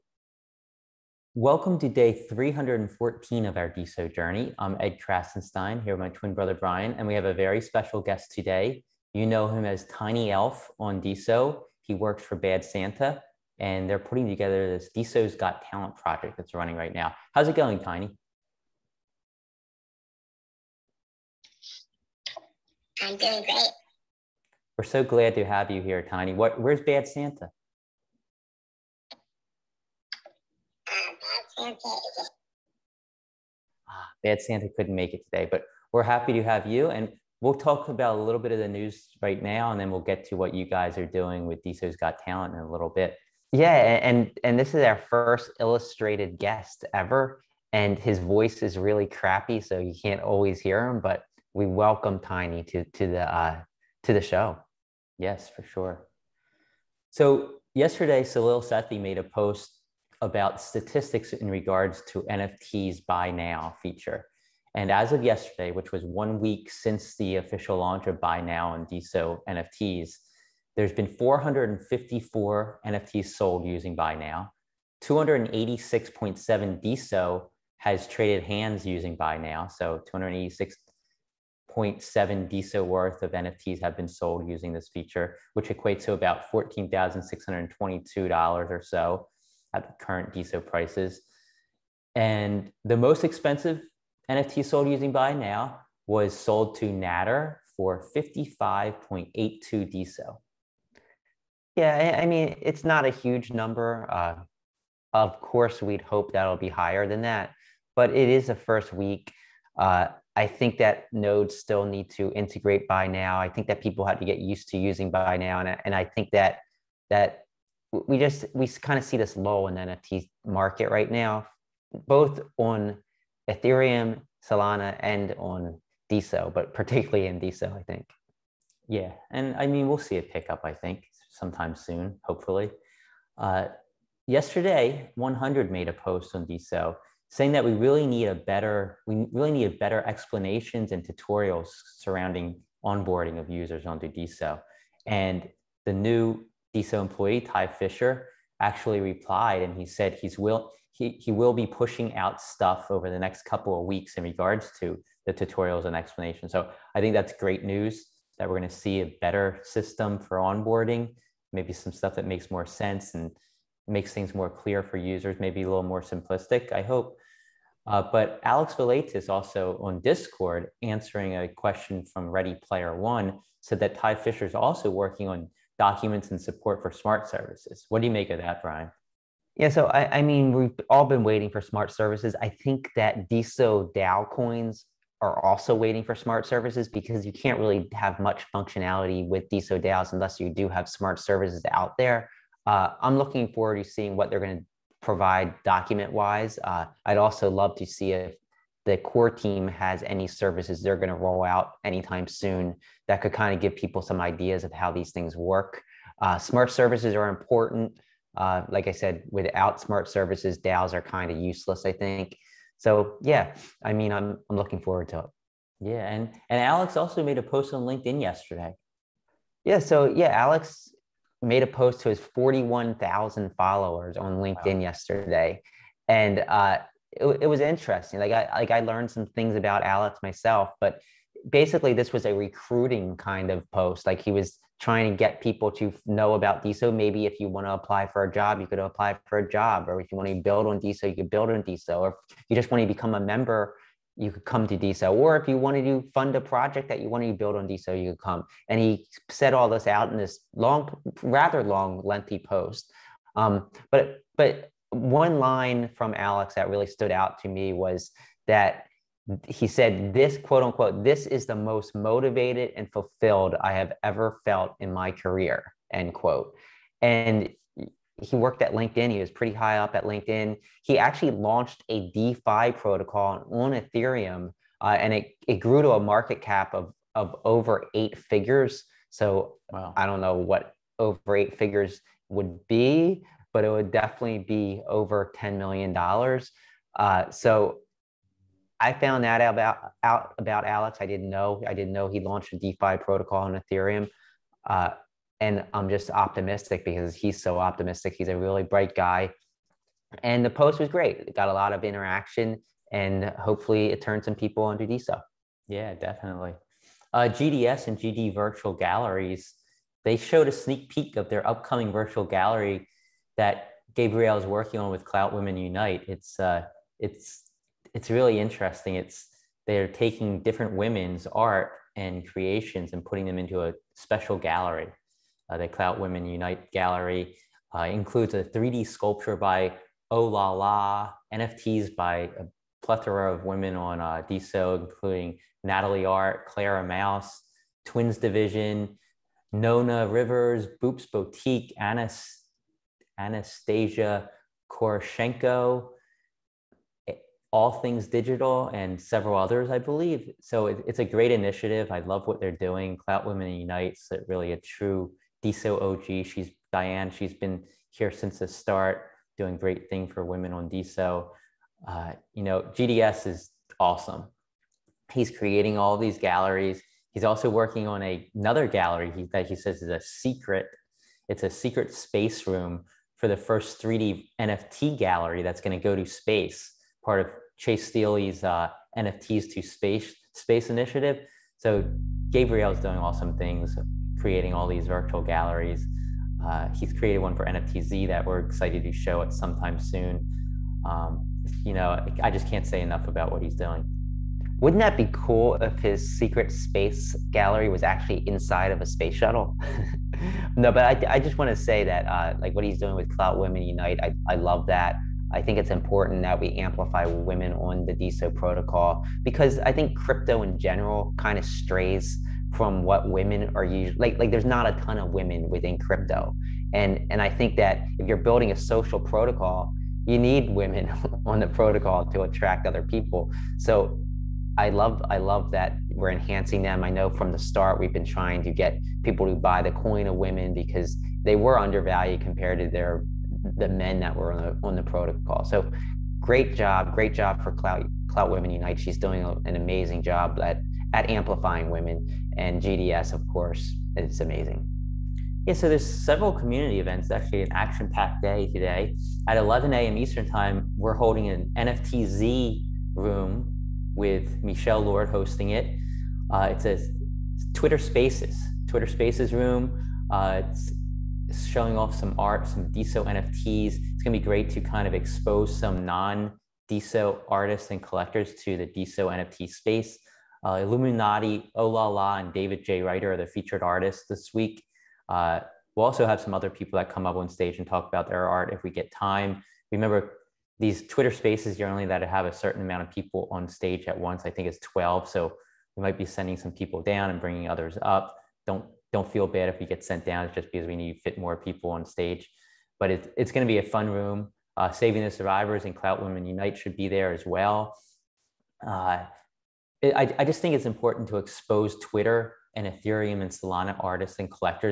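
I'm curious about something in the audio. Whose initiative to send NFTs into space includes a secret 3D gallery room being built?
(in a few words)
Chase Steely.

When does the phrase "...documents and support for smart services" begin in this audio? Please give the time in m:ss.
2:55.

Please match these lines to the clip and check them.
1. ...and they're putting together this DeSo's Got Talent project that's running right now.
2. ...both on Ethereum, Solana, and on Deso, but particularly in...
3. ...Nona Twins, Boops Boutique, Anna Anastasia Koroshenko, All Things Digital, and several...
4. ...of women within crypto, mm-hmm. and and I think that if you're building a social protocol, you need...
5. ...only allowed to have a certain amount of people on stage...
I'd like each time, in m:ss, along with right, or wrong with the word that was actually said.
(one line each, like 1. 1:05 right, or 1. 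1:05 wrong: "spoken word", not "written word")
1. 0:13 right
2. 2:02 right
3. 5:39 wrong: "Rivers", not "Twins"
4. 6:54 right
5. 8:01 right.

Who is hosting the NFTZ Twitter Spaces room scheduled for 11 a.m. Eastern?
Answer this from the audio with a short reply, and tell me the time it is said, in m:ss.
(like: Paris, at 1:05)
Michelle Lord, at 7:34.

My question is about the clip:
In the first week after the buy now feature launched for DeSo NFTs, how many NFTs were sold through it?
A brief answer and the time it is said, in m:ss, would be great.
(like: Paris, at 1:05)
454, at 1:11.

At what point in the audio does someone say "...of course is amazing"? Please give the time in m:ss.
7:23.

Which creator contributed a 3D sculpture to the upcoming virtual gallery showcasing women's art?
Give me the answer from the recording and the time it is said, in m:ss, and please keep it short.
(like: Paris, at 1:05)
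Oh La La, at 5:30.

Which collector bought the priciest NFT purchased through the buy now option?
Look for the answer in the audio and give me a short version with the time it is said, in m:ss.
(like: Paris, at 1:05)
Natter, at 1:36.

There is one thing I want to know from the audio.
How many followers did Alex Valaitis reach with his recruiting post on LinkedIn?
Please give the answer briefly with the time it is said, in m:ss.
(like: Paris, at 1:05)
41,000, at 3:42.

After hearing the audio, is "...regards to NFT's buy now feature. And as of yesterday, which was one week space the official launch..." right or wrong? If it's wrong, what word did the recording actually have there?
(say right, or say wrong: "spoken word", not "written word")
wrong: "since", not "space".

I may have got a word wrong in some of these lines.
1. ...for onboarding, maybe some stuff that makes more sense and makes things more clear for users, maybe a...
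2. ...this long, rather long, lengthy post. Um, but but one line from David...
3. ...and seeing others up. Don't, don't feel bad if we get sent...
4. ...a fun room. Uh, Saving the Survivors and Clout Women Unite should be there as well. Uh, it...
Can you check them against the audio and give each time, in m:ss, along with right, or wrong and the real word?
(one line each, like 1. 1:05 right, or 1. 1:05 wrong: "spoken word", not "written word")
1. 2:40 right
2. 4:10 wrong: "Alex", not "David"
3. 8:07 wrong: "bringing", not "seeing"
4. 8:13 right.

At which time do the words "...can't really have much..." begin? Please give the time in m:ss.
3:07.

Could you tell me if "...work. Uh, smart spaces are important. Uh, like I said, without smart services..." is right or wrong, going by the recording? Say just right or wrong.
wrong.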